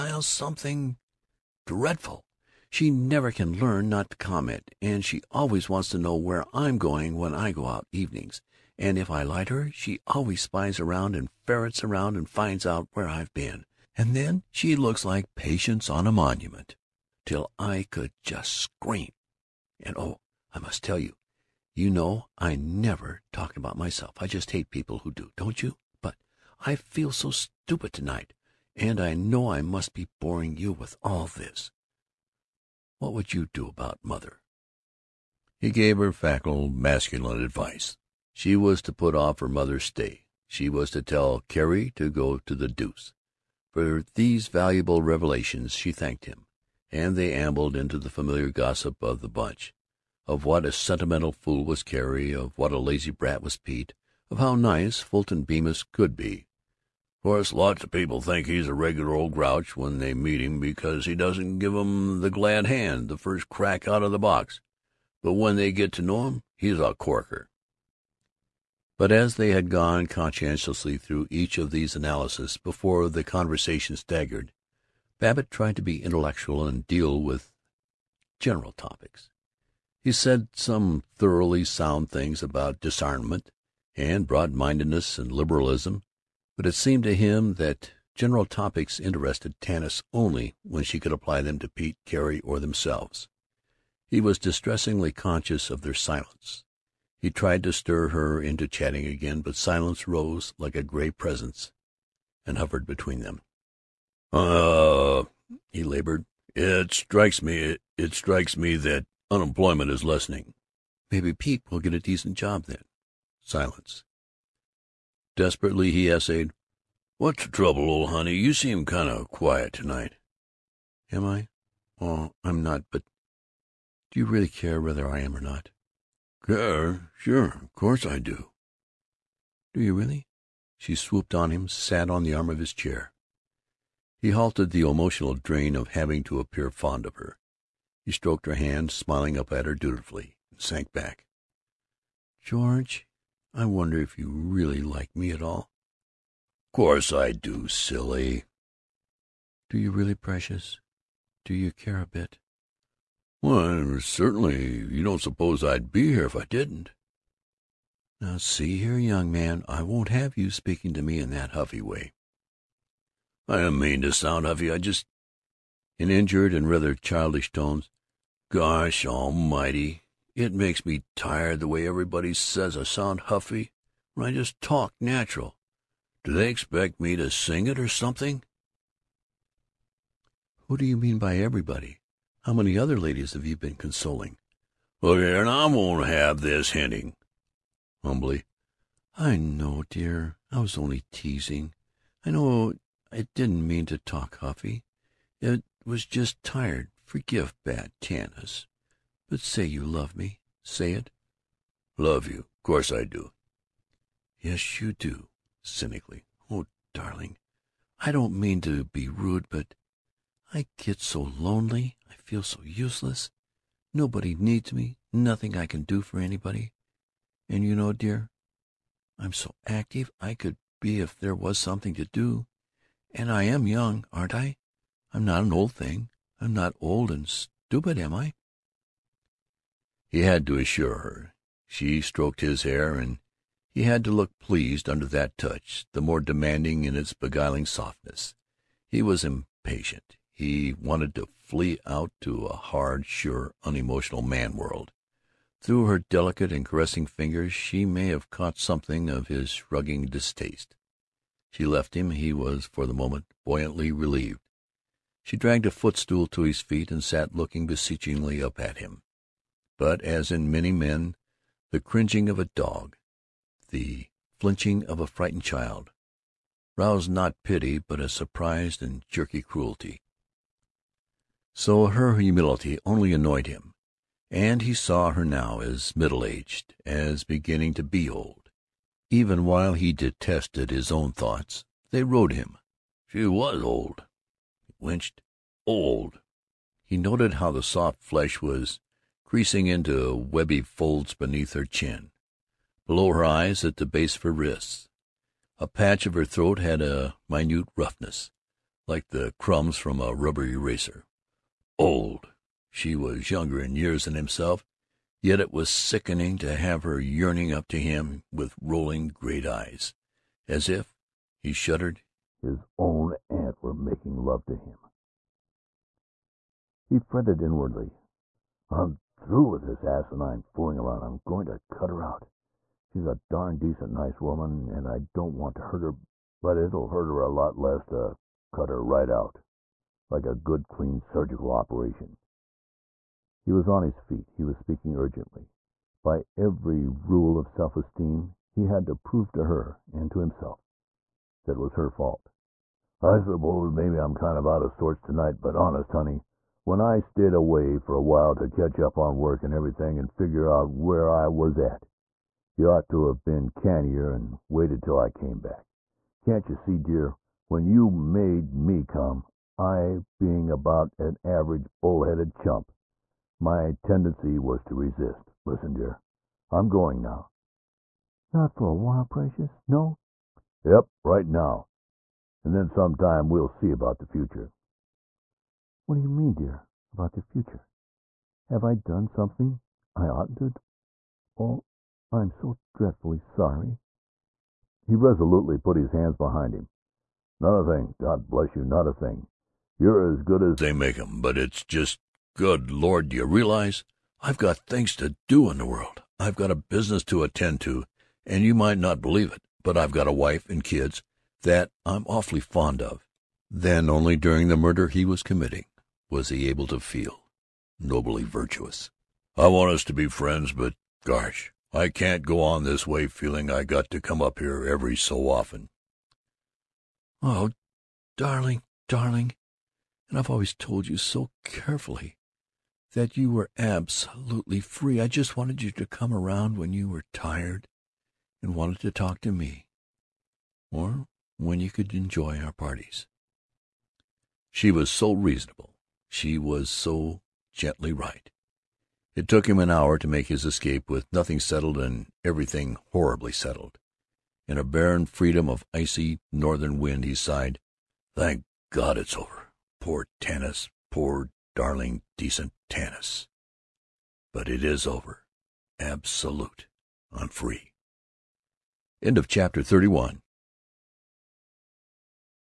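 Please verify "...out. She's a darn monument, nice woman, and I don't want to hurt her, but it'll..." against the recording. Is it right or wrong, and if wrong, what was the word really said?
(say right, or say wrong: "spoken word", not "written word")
wrong: "decent", not "monument".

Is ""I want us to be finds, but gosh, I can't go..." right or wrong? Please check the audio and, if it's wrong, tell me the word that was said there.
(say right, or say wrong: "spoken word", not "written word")
wrong: "friends", not "finds".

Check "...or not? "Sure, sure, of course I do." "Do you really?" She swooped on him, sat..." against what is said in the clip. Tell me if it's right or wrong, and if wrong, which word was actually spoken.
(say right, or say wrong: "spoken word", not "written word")
right.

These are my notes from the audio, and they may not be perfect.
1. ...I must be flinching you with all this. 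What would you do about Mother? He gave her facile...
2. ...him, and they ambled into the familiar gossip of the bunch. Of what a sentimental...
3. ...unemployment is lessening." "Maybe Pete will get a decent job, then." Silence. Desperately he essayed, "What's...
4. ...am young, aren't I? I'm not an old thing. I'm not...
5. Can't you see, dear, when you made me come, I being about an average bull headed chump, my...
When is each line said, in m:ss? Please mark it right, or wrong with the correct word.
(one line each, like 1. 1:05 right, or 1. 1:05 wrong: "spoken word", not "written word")
1. 0:29 wrong: "boring", not "flinching"
2. 0:46 right
3. 1:49 right
4. 3:43 right
5. 5:56 right.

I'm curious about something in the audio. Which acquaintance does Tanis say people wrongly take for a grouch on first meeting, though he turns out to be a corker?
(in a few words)
Fulton Bemis.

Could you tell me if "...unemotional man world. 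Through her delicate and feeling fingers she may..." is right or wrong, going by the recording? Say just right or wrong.
wrong.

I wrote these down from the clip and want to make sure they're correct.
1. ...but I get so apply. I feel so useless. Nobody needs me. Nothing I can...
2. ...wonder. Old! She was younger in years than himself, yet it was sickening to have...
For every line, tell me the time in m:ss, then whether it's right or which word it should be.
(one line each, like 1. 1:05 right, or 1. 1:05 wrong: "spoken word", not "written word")
1. 3:29 wrong: "lonely", not "apply"
2. 5:00 wrong: "eraser", not "wonder".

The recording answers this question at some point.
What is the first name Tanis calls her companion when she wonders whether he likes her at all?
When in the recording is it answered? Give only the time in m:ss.
2:22.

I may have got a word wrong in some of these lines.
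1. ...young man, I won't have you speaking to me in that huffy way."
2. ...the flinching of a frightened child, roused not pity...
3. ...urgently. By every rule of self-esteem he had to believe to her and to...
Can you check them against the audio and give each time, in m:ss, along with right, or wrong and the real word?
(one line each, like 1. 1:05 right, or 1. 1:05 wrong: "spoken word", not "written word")
1. 2:38 right
2. 4:23 right
3. 5:34 wrong: "prove", not "believe".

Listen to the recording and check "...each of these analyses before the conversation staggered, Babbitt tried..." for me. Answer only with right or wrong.
right.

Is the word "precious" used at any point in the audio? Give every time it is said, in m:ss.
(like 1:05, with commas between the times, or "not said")
2:30, 6:09.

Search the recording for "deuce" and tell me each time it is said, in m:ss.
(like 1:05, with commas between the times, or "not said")
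0:42.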